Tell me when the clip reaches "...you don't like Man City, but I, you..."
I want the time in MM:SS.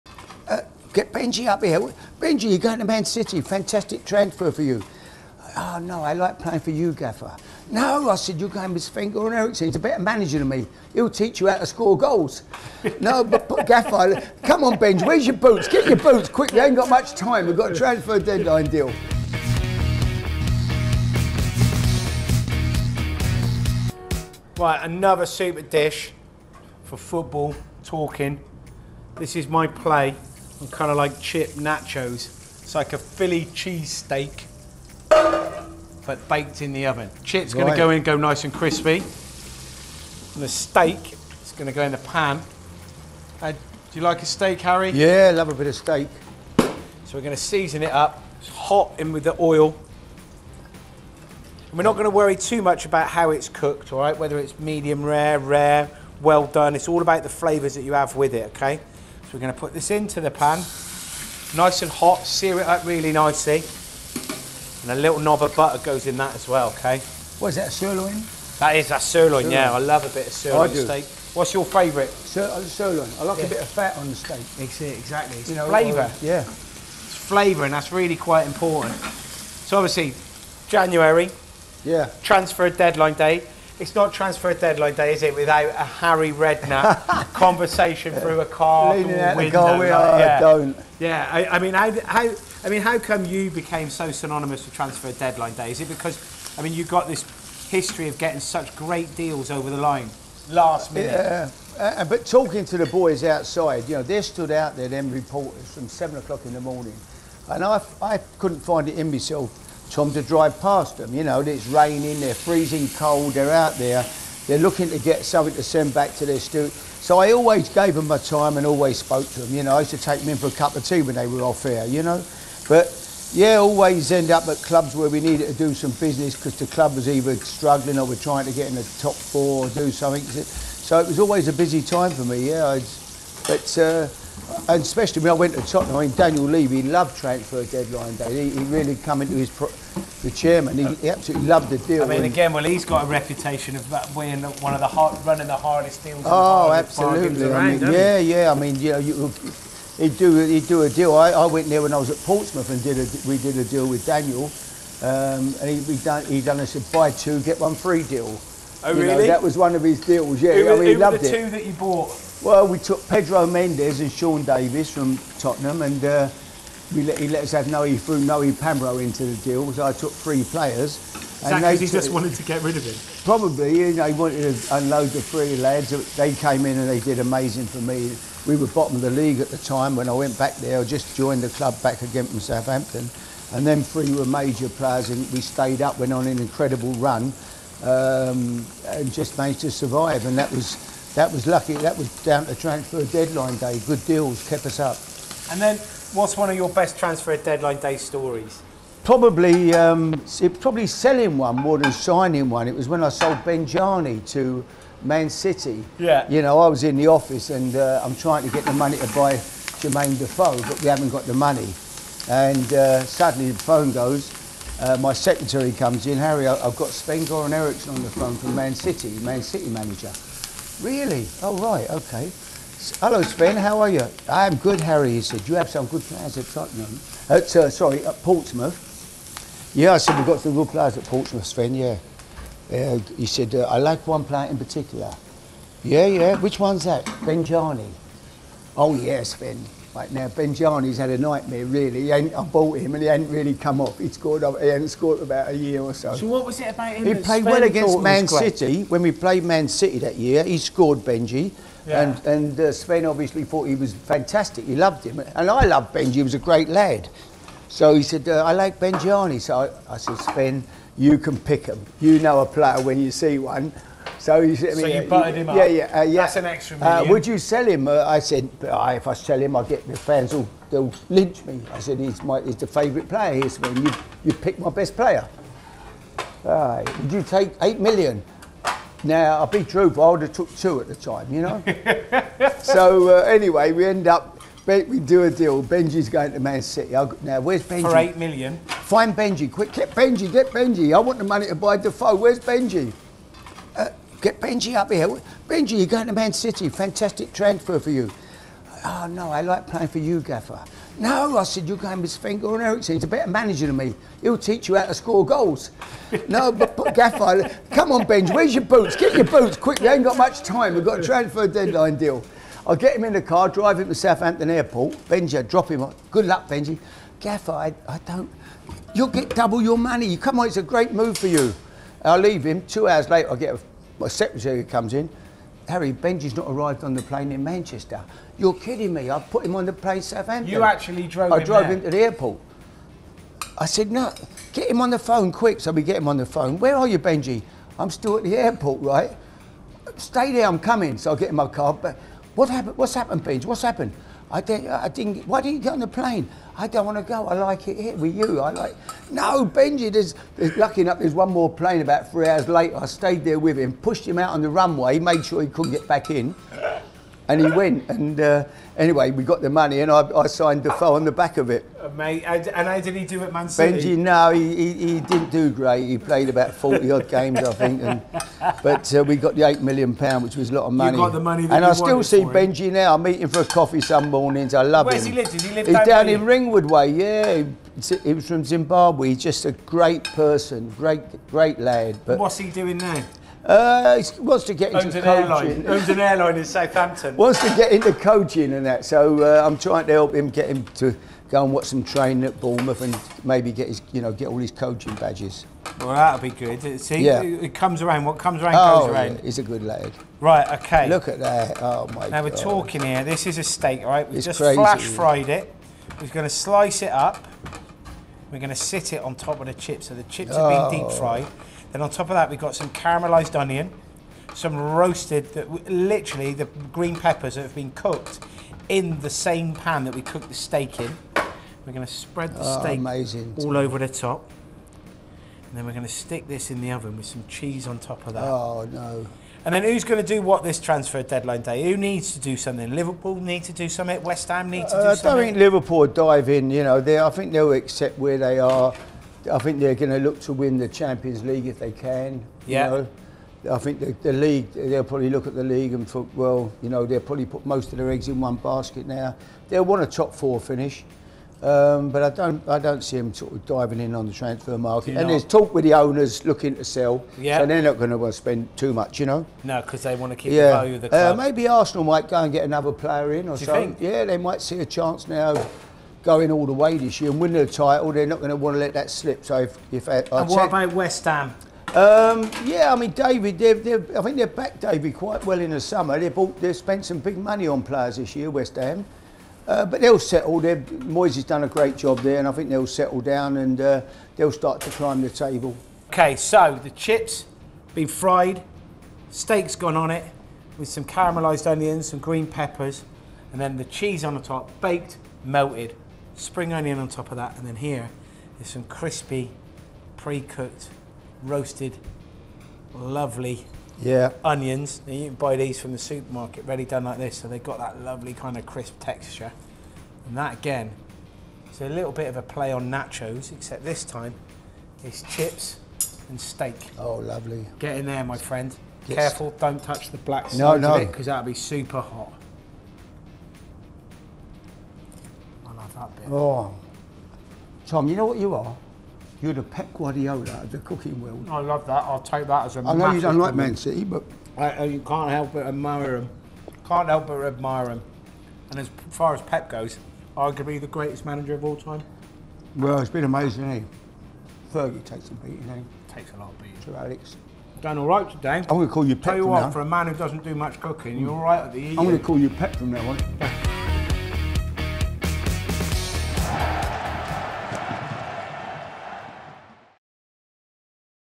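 08:52.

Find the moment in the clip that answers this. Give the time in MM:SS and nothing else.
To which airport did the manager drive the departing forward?
05:13.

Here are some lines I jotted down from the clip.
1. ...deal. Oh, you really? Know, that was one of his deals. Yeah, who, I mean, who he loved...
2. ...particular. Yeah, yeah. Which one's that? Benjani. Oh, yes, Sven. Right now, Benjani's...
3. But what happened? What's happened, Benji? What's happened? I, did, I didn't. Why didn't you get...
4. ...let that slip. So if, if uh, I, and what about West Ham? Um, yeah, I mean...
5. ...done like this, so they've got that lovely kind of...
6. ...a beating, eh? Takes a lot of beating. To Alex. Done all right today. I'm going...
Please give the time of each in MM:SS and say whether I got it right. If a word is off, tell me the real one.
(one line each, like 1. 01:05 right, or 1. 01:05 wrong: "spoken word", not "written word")
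1. 02:38 right
2. 03:54 right
3. 05:41 right
4. 07:48 right
5. 08:26 right
6. 09:05 right.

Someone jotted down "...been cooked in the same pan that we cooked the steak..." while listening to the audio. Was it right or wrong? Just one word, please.
right.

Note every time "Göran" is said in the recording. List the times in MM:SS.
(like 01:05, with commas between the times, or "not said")
00:08, 05:02.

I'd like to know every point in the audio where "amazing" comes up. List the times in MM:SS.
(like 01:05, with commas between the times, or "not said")
02:57, 07:02, 09:03.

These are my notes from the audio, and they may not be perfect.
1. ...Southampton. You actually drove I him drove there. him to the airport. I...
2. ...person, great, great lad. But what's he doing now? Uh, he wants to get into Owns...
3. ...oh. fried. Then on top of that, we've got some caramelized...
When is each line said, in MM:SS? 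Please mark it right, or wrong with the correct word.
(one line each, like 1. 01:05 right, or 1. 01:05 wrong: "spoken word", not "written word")
1. 05:30 right
2. 06:20 right
3. 06:50 right.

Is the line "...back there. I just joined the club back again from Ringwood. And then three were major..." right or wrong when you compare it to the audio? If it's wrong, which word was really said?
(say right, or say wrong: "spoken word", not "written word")
wrong: "Southampton", not "Ringwood".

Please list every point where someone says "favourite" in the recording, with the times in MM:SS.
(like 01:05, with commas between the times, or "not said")
01:11, 04:32.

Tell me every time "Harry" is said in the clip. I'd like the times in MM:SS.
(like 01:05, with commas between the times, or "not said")
00:44, 01:25, 03:36, 03:44, 05:25.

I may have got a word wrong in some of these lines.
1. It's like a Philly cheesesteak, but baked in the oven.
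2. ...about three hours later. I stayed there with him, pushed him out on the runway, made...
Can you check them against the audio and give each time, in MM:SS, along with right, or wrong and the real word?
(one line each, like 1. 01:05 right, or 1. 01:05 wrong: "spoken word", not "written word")
1. 00:32 right
2. 05:51 right.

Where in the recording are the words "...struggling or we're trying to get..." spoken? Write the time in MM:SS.
02:07.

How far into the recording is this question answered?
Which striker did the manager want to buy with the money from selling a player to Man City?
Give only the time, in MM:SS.
03:29.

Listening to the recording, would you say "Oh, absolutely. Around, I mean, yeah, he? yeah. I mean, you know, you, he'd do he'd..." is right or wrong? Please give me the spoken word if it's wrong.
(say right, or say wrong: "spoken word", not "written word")
right.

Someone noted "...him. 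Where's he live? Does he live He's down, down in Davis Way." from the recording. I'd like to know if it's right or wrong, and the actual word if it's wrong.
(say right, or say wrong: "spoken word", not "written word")
wrong: "Ringwood", not "Davis".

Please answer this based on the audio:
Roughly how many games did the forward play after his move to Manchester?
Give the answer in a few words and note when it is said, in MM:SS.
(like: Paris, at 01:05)
About 40, at 06:06.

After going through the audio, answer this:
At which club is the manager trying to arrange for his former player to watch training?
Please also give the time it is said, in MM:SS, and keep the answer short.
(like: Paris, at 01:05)
Bournemouth, at 06:32.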